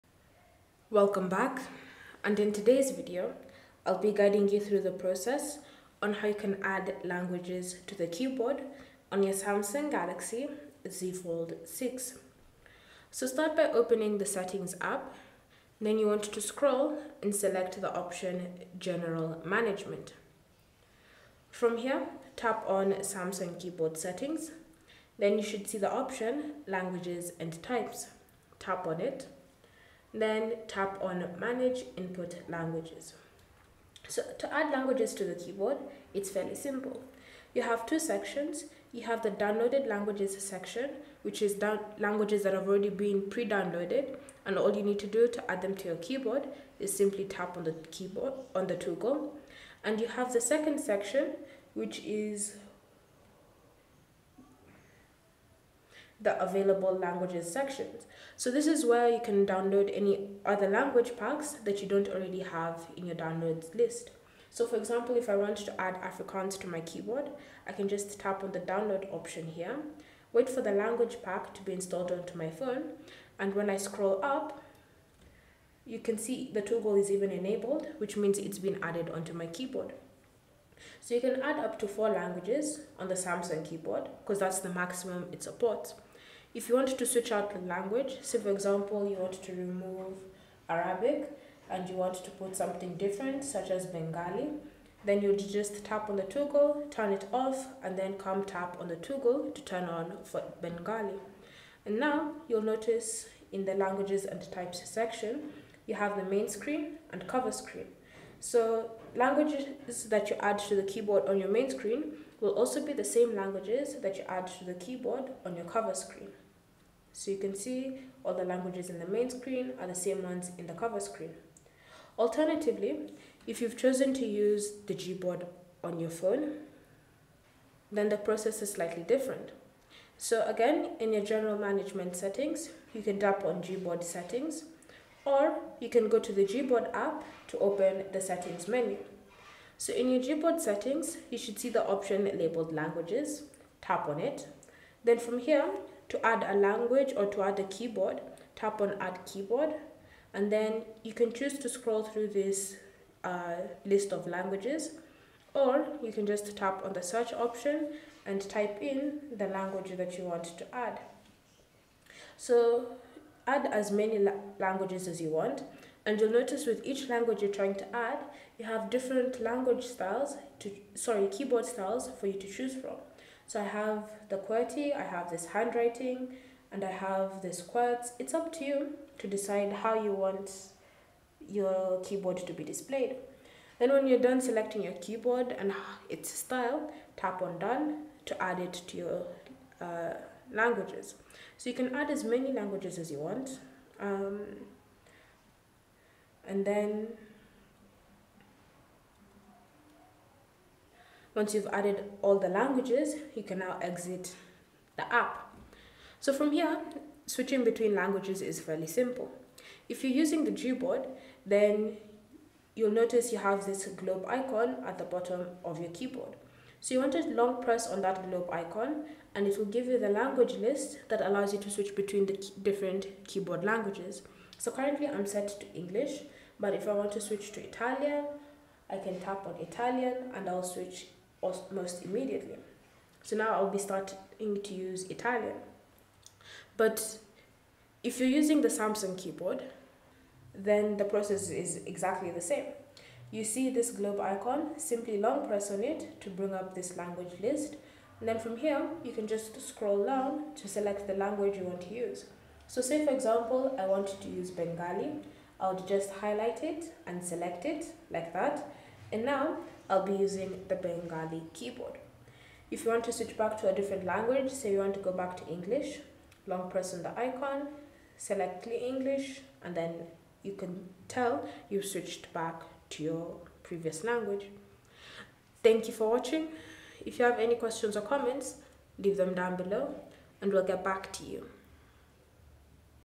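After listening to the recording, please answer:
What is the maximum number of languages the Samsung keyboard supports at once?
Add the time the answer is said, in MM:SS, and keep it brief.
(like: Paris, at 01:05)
4, at 01:21.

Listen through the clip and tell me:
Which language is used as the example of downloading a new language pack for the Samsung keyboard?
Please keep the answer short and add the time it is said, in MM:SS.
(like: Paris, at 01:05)
Afrikaans, at 01:06.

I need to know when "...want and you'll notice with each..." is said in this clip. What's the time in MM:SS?
02:45.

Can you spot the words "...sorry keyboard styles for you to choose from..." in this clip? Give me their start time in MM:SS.
02:50.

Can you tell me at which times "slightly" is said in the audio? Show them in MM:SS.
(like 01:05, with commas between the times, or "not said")
02:08.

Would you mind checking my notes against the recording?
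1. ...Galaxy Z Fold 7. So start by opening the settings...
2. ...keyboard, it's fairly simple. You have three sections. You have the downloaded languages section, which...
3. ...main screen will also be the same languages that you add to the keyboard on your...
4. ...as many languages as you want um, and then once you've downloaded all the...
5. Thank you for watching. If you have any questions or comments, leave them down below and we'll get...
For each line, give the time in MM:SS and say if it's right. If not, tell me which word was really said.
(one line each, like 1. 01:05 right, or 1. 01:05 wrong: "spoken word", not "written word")
1. 00:09 wrong: "6", not "7"
2. 00:35 wrong: "two", not "three"
3. 01:51 right
4. 03:12 wrong: "added", not "downloaded"
5. 04:35 right.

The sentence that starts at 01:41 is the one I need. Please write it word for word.
And now you'll notice in the languages and types section, you have the main screen and cover screen.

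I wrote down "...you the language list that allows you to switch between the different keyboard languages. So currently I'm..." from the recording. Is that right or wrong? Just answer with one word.
right.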